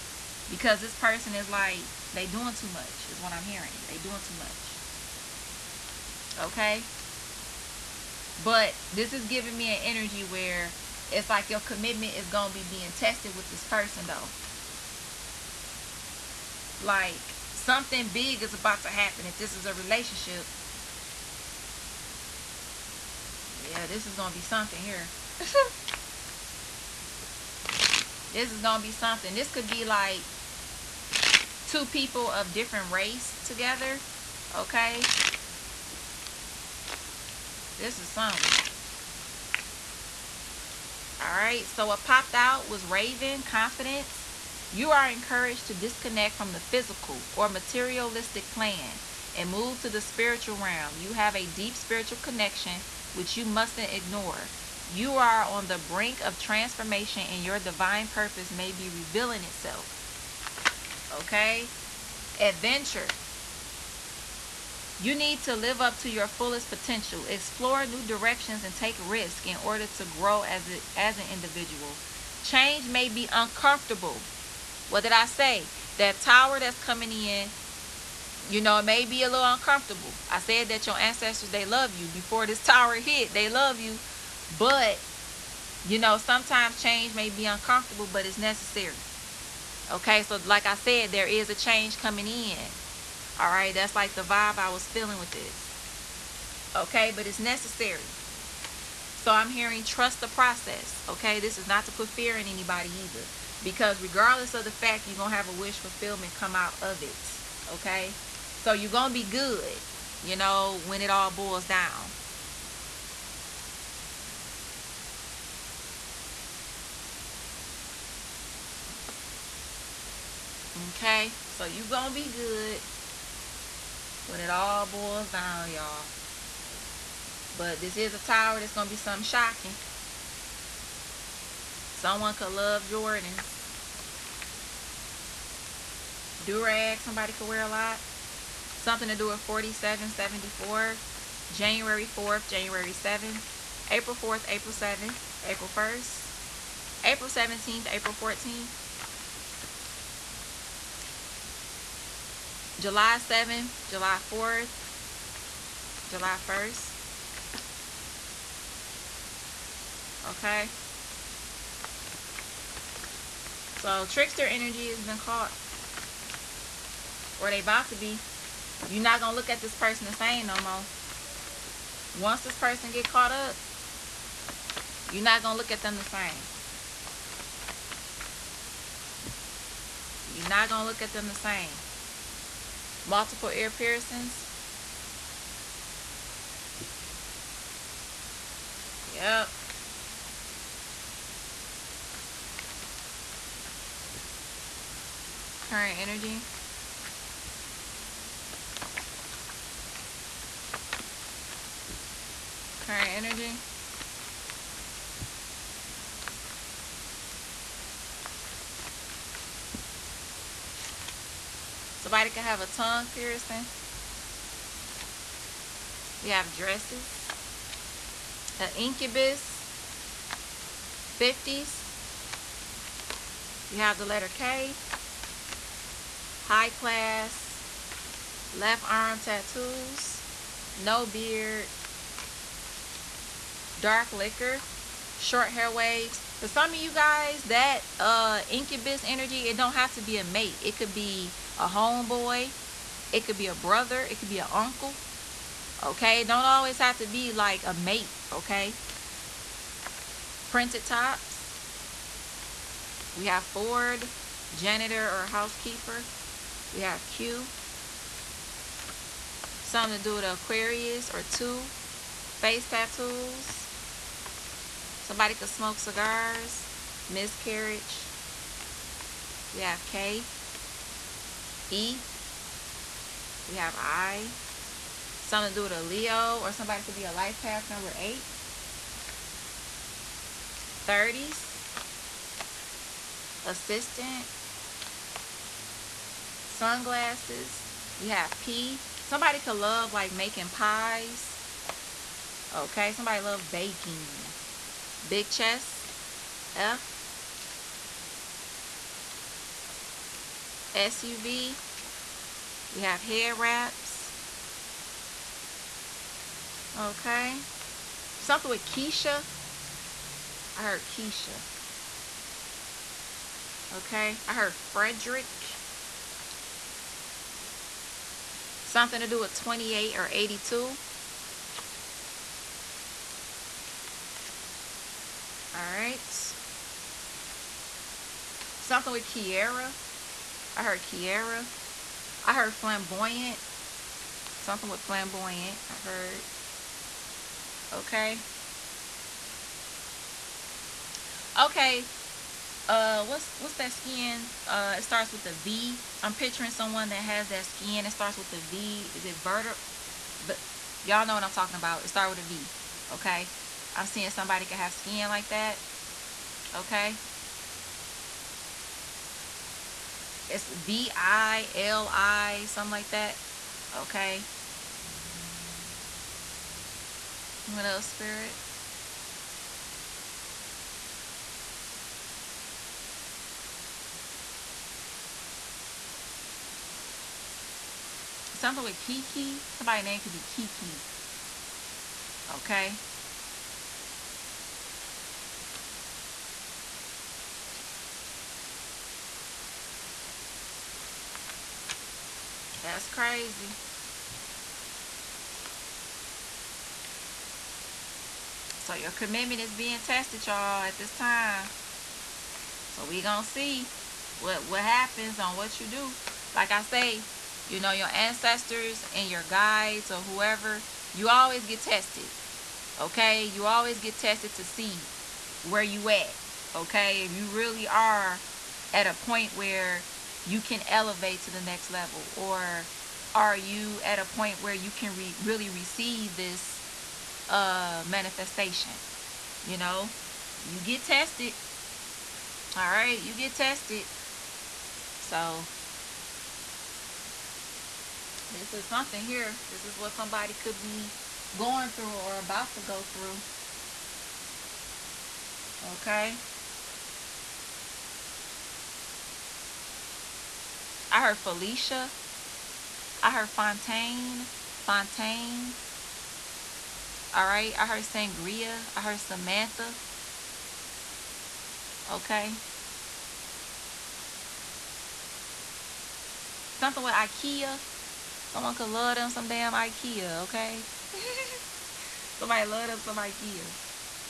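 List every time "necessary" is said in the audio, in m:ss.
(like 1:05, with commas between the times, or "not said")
1:28, 1:37.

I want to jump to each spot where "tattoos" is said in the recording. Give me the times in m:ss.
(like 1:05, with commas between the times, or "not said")
3:49, 4:22.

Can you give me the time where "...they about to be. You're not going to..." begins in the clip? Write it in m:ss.
2:47.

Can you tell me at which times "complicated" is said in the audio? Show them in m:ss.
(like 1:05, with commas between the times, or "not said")
not said.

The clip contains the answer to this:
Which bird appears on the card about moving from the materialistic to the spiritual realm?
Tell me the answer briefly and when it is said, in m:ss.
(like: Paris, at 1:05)
Raven, at 0:42.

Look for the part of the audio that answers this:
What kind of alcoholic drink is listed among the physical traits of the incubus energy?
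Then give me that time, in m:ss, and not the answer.
3:53.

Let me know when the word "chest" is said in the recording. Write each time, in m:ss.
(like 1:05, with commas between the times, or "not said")
4:55.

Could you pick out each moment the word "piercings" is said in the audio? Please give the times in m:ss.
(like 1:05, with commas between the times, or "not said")
3:03, 3:33.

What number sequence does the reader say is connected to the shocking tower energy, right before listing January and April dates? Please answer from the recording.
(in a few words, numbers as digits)
4774.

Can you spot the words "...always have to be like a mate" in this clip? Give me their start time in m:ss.
4:06.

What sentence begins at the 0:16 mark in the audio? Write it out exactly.
Like Something big is about to happen if this is a relationship.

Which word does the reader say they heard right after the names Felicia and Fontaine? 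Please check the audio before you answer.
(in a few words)
Sangria.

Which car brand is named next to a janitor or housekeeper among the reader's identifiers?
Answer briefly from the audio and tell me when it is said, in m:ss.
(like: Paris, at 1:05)
Ford, at 4:13.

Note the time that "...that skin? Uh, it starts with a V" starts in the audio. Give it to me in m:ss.
5:43.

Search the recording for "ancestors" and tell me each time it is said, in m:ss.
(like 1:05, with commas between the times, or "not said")
1:20, 6:47.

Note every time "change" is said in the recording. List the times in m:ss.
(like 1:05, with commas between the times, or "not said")
1:12, 1:26, 1:31.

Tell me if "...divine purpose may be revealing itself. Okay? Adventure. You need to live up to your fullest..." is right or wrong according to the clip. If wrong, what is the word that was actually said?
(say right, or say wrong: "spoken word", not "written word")
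right.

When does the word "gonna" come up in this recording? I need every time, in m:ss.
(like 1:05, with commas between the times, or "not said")
6:43.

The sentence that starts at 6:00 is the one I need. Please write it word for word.
It's V I L I, something like that.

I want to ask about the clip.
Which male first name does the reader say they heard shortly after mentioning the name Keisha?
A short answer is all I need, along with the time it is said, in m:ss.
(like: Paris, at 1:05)
Frederick, at 5:14.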